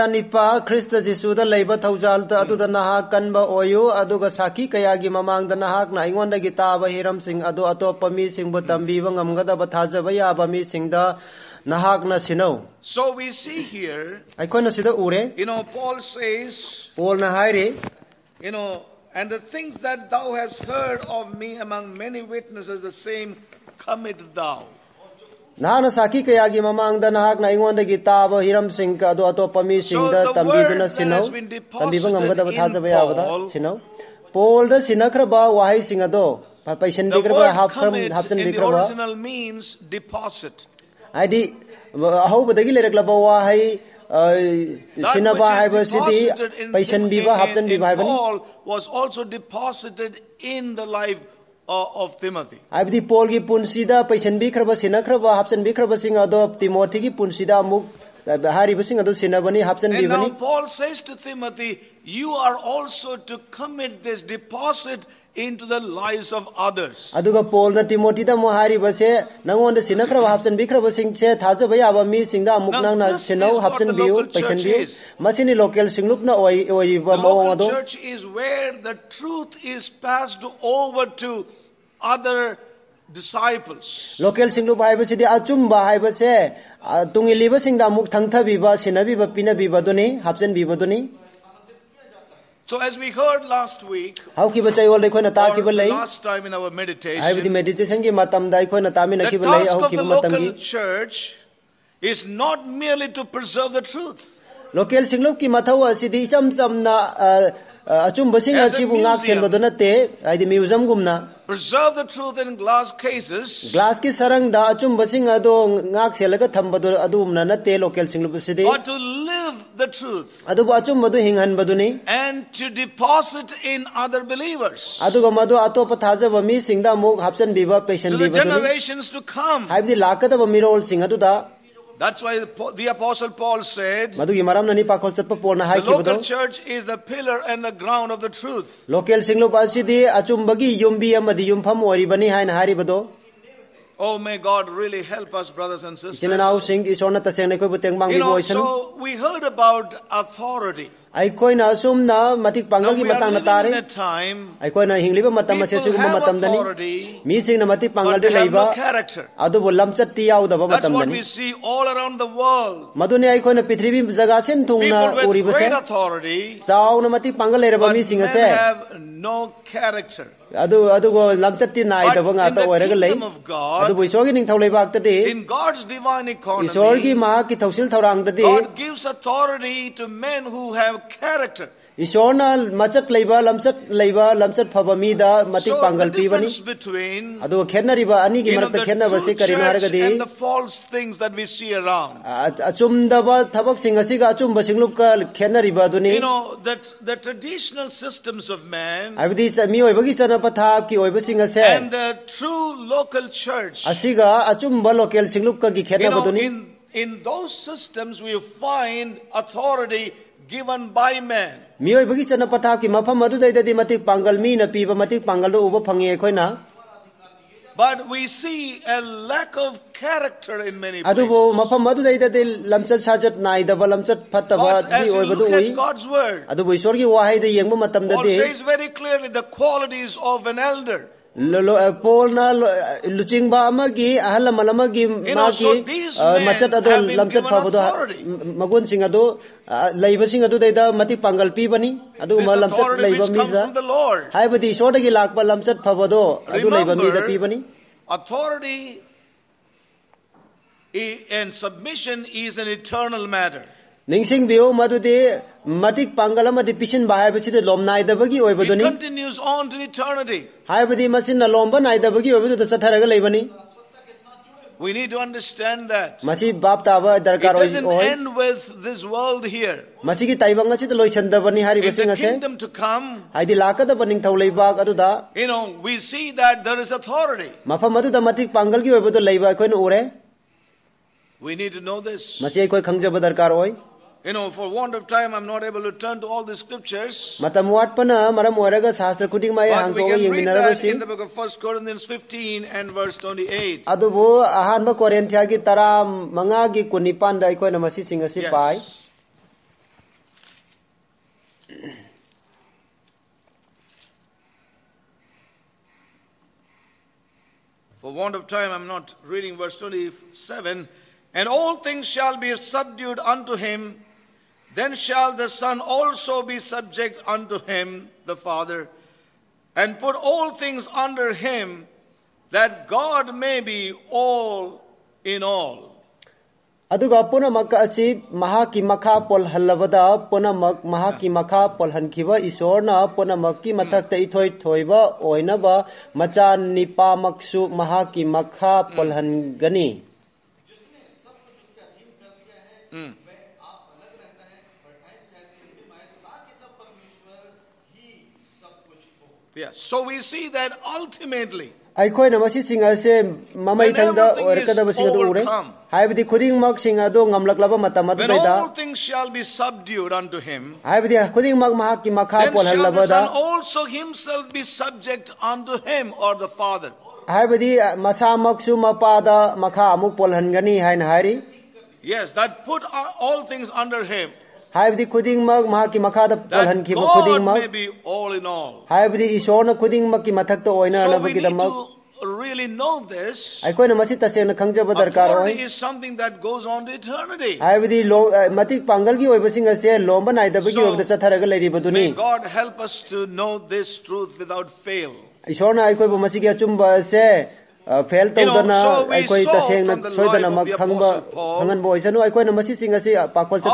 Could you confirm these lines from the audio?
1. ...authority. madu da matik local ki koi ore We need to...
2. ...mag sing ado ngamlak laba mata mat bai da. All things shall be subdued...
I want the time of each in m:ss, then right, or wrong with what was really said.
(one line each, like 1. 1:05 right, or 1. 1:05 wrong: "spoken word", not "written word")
1. 4:36 wrong: "pangal", not "local"
2. 5:56 right.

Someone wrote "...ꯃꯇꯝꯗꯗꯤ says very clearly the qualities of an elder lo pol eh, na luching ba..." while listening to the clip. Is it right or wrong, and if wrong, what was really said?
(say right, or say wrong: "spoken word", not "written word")
right.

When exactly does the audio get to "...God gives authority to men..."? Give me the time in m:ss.
2:57.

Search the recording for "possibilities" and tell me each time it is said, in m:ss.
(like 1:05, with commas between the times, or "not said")
not said.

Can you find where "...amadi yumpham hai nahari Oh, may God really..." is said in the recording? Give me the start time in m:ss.
2:21.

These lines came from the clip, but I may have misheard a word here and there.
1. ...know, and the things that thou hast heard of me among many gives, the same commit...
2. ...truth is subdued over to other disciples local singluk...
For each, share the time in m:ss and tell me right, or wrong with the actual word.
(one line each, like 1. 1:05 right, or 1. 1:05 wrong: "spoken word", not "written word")
1. 0:18 wrong: "witnesses", not "gives"
2. 1:19 wrong: "passed", not "subdued".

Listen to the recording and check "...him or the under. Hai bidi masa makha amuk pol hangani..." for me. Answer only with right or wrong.
wrong.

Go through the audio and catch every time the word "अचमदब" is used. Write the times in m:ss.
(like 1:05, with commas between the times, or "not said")
3:12.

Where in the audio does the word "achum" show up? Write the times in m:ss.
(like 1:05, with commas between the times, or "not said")
1:25, 2:19.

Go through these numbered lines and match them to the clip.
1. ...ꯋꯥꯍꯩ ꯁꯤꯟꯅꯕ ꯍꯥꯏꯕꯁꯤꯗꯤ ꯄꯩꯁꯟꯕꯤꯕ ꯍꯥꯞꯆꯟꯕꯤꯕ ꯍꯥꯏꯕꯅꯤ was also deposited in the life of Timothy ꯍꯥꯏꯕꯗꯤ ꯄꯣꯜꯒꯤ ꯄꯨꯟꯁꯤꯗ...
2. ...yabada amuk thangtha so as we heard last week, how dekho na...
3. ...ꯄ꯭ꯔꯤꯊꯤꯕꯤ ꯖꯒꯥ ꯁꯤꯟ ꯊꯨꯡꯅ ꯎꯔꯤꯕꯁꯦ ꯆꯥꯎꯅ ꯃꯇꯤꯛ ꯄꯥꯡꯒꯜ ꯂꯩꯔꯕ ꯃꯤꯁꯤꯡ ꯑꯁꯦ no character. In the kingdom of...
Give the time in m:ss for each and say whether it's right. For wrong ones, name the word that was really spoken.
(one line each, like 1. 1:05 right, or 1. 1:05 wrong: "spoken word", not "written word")
1. 0:43 right
2. 1:27 wrong: "singda", not "yabada"
3. 2:43 right.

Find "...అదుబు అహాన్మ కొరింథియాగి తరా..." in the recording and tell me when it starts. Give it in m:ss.
4:53.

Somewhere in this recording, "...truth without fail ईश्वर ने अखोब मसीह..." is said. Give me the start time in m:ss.
6:34.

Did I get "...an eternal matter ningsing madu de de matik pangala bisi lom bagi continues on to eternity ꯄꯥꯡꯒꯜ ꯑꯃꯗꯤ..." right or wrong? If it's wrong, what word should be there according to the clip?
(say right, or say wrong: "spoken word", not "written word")
right.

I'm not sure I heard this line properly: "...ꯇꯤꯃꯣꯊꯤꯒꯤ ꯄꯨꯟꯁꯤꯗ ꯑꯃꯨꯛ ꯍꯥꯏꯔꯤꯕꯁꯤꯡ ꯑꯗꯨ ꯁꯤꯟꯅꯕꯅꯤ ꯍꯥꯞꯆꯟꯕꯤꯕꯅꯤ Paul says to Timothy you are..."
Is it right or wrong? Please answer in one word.
right.